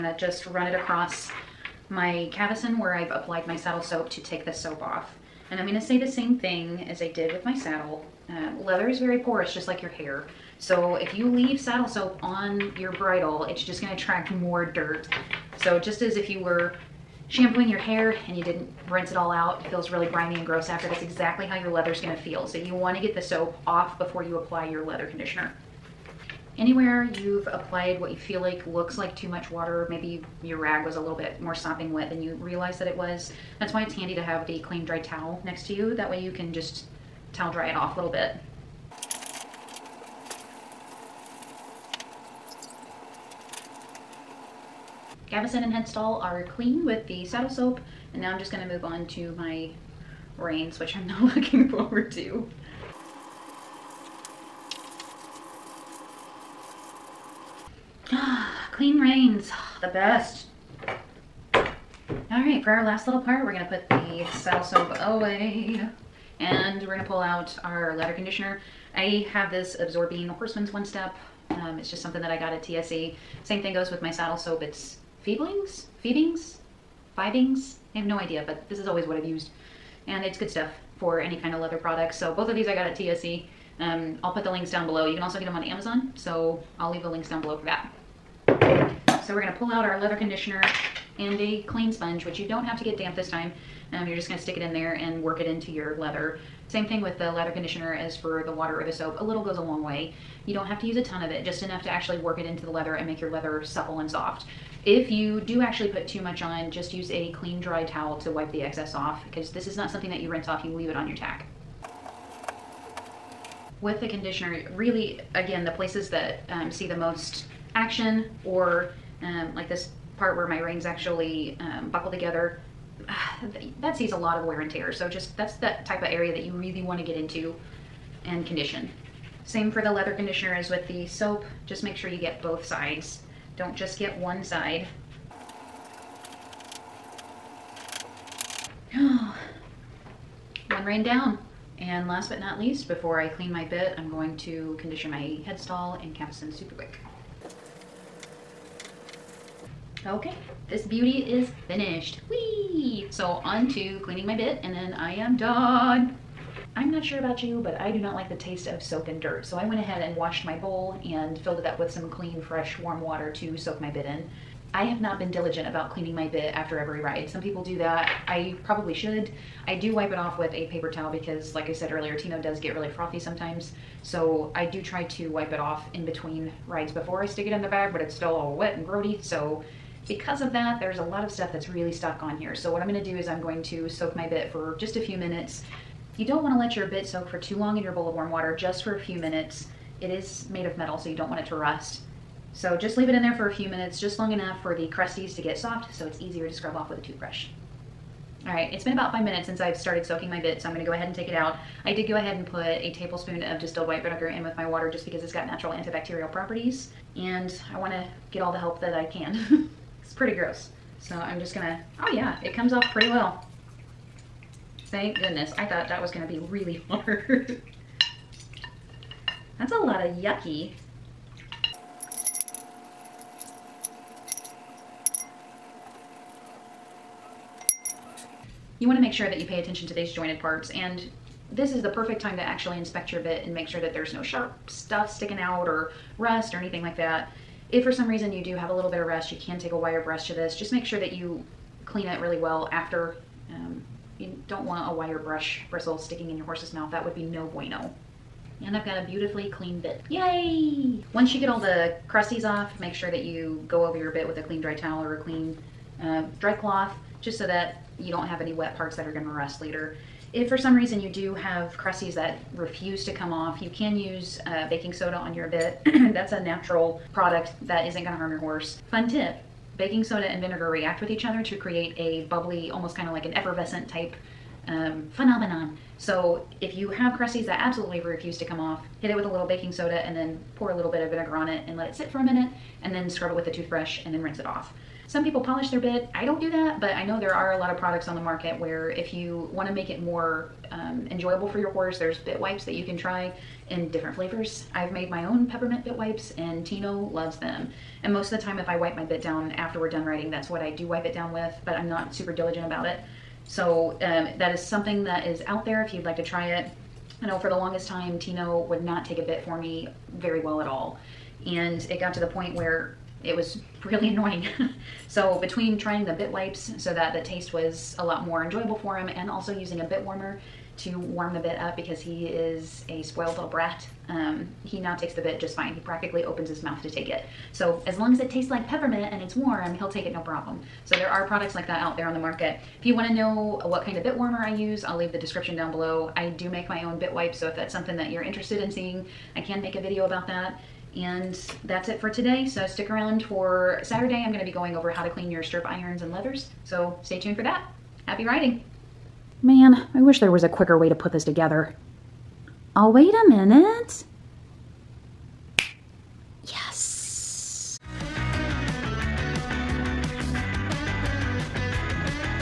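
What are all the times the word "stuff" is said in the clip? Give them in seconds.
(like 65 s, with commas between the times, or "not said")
80 s, 181 s, 234 s.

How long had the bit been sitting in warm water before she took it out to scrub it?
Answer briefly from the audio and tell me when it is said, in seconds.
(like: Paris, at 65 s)
5 minutes, at 199 s.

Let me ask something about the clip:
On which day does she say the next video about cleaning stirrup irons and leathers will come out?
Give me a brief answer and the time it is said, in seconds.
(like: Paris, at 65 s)
Saturday, at 343 s.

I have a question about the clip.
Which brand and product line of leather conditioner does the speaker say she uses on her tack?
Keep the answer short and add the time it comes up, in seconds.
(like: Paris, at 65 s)
Absorbine Horseman's One Step, at 69 s.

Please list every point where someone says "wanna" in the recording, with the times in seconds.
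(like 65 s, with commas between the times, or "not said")
22 s, 186 s, 207 s, 228 s.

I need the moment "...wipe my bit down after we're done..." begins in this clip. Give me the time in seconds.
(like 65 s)
298 s.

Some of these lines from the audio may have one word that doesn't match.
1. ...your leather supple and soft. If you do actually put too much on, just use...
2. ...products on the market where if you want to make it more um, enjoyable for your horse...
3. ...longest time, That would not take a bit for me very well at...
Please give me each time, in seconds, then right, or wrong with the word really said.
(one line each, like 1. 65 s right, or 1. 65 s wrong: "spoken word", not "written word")
1. 103 s right
2. 287 s right
3. 307 s wrong: "Tino", not "That".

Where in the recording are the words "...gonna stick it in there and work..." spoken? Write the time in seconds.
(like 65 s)
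94 s.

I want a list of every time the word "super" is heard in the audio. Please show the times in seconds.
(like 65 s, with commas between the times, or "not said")
146 s, 302 s.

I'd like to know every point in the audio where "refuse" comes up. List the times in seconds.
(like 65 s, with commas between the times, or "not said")
262 s, 277 s.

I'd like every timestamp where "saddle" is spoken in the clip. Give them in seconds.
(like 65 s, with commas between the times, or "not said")
3 s, 7 s, 11 s, 47 s, 64 s, 74 s.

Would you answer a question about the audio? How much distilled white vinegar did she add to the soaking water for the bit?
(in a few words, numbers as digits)
A tablespoon.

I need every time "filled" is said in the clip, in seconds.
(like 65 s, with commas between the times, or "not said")
161 s.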